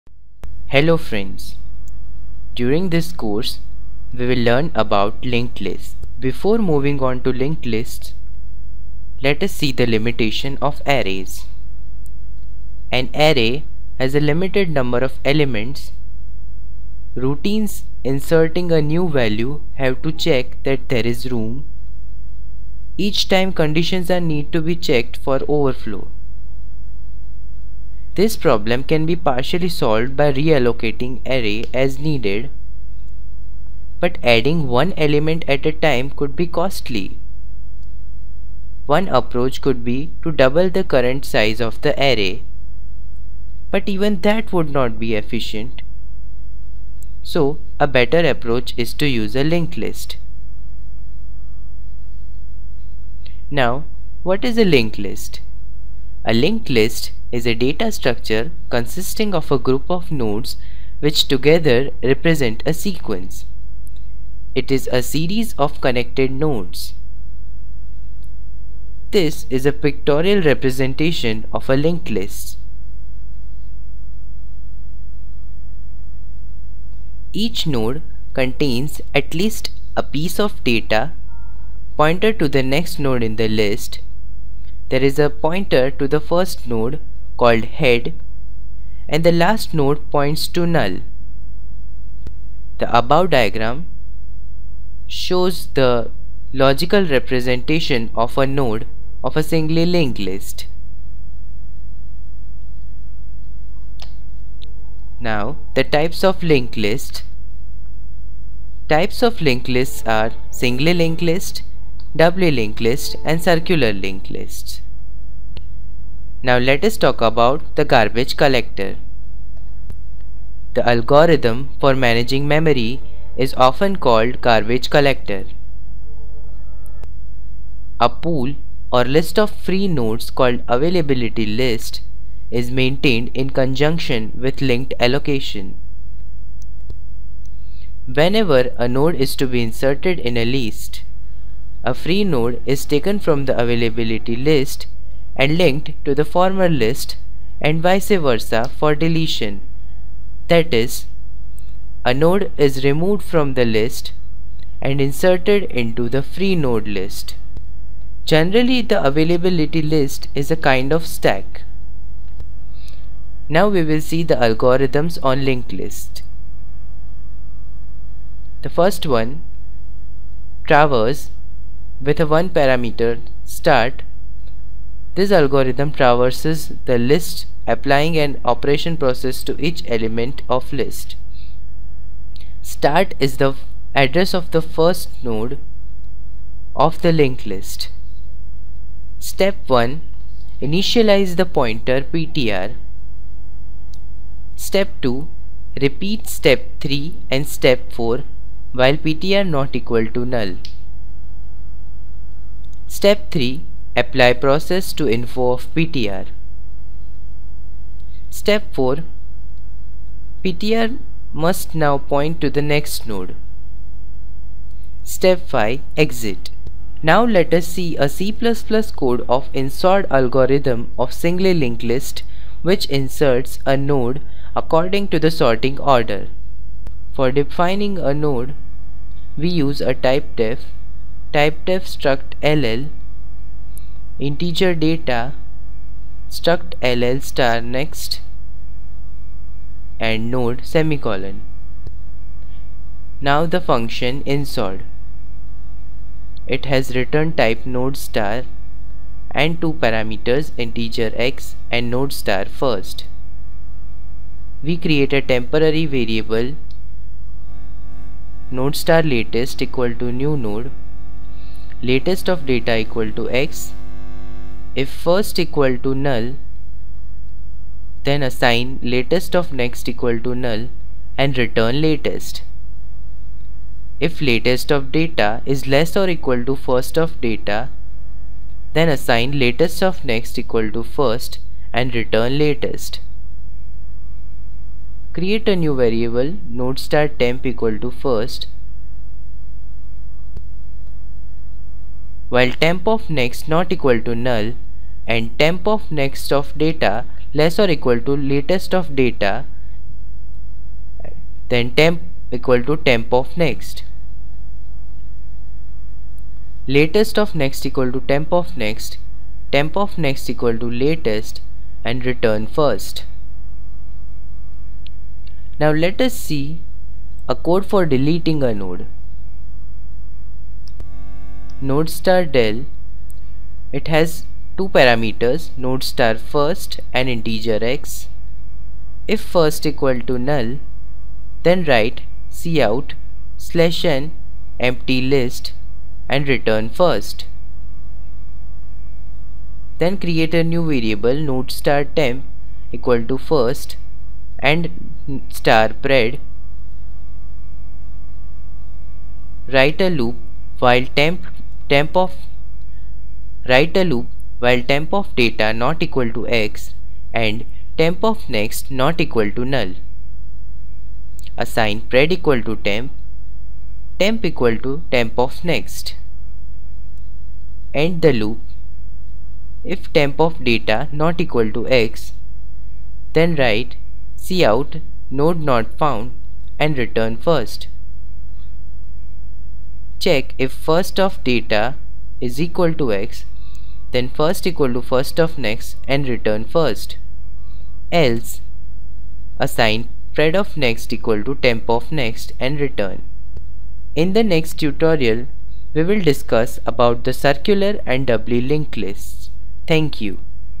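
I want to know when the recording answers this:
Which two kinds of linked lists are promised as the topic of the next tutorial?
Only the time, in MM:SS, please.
06:37.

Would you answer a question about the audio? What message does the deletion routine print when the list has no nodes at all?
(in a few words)
empty list.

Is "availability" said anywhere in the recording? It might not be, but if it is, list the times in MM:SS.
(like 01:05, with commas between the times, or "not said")
02:10, 02:23, 02:39.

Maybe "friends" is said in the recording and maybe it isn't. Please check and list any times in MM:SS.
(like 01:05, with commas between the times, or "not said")
00:00.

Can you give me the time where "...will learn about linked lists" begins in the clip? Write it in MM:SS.
00:04.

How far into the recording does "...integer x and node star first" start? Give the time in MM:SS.
04:10.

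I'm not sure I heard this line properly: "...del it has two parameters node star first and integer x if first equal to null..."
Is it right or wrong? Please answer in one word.
right.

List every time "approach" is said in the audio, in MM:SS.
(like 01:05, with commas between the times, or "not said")
00:39, 00:48.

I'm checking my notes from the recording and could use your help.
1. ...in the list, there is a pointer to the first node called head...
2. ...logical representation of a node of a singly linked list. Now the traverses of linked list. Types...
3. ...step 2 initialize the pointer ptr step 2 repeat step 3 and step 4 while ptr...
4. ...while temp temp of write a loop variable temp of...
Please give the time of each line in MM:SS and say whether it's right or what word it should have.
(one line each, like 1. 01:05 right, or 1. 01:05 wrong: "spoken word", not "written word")
1. 01:23 right
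2. 01:36 wrong: "types", not "traverses"
3. 03:09 wrong: "1", not "2"
4. 05:50 wrong: "while", not "variable".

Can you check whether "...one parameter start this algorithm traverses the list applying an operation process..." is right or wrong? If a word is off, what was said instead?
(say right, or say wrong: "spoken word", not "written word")
right.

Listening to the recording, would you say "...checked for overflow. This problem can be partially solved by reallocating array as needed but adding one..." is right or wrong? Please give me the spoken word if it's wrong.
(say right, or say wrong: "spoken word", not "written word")
right.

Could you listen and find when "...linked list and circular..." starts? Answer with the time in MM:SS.
01:52.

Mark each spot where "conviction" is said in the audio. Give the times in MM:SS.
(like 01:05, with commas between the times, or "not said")
not said.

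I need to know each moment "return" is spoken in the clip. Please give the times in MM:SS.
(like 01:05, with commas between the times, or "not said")
04:06, 04:31, 04:41, 05:12, 05:36, 06:16, 06:26, 06:32.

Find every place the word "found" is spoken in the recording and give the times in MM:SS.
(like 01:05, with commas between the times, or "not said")
06:15.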